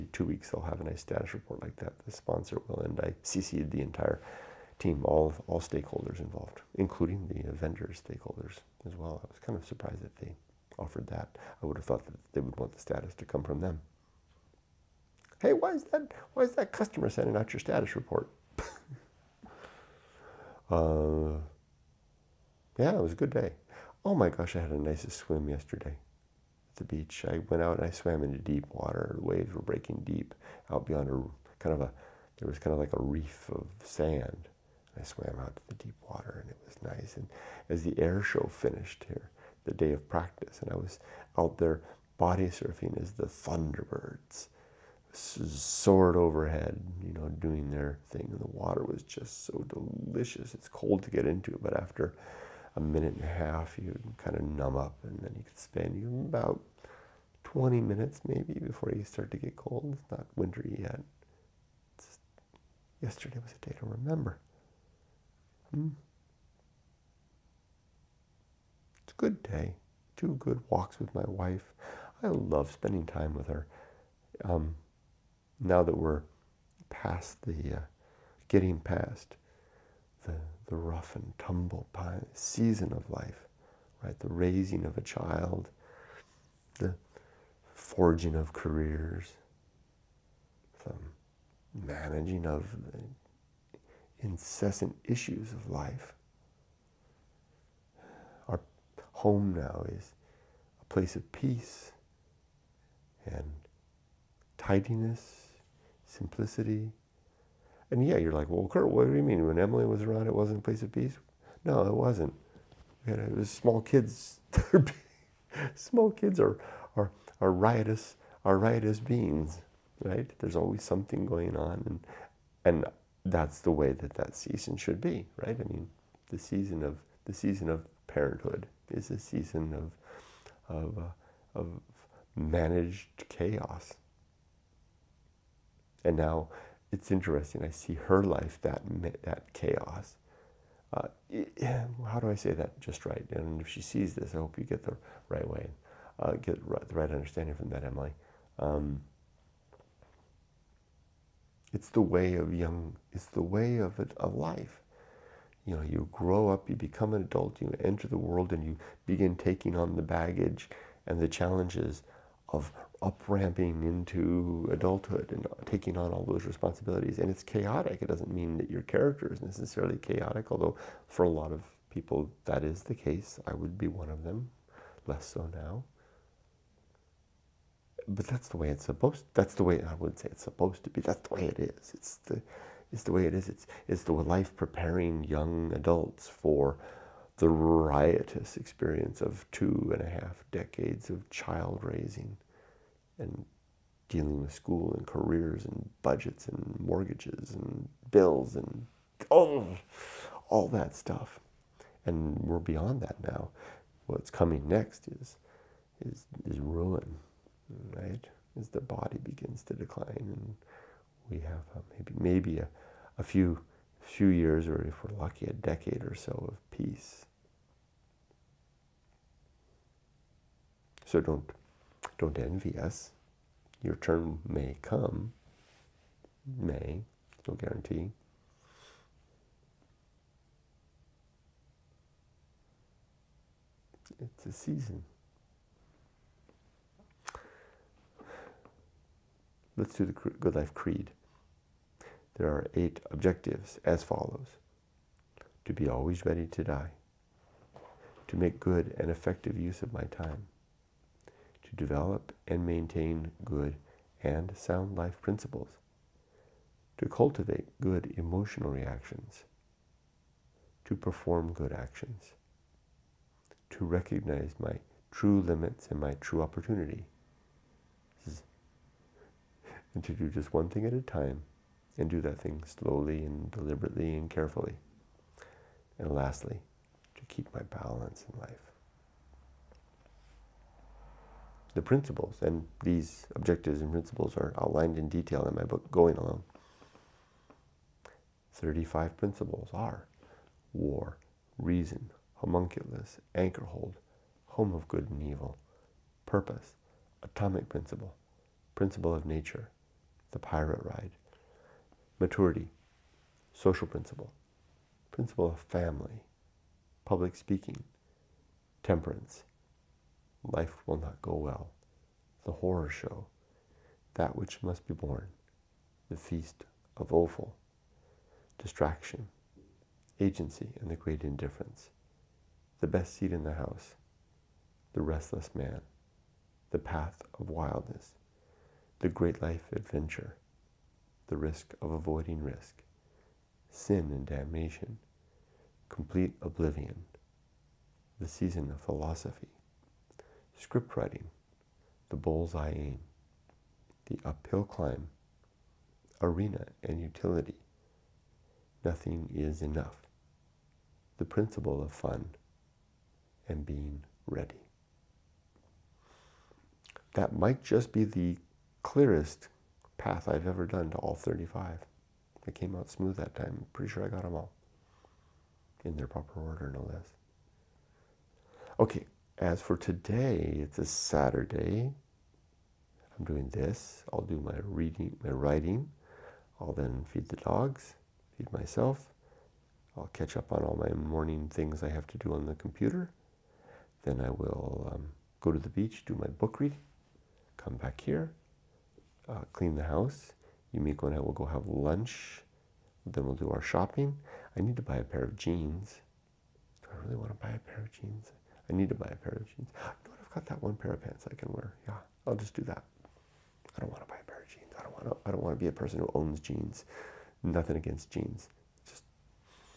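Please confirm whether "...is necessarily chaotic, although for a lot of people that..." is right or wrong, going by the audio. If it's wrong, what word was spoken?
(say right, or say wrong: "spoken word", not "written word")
right.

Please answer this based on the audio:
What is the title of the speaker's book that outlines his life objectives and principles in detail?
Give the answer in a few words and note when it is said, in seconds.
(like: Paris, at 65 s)
Going Alone, at 285 s.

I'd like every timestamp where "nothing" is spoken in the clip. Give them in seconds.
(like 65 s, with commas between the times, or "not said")
348 s, 407 s.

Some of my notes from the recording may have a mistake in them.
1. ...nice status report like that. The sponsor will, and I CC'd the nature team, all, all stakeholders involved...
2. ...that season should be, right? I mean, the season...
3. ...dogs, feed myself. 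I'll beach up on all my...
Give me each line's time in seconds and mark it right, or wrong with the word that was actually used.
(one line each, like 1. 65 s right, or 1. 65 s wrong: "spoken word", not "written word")
1. 0 s wrong: "entire", not "nature"
2. 124 s right
3. 377 s wrong: "catch", not "beach".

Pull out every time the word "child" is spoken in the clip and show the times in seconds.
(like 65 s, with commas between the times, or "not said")
85 s, 191 s.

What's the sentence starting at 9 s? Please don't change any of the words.
I was kind of surprised that they offered that.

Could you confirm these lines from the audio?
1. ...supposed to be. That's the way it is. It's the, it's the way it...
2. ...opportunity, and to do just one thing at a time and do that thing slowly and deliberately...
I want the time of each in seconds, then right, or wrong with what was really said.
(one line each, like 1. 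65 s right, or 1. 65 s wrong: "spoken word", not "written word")
1. 180 s right
2. 266 s right.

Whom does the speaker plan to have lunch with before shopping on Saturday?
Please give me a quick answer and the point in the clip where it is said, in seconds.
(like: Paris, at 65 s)
Yumiko, at 390 s.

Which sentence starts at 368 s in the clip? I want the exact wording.
Okay, as for today, it's a Saturday.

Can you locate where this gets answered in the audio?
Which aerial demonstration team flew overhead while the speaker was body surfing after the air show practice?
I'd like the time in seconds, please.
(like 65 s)
43 s.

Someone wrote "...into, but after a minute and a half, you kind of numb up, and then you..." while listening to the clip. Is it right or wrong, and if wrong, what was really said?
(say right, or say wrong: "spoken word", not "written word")
right.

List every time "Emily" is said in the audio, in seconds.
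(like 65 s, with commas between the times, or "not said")
109 s, 147 s.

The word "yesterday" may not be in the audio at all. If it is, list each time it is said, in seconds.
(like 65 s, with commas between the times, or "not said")
25 s, 63 s.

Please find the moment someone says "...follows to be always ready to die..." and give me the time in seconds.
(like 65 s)
244 s.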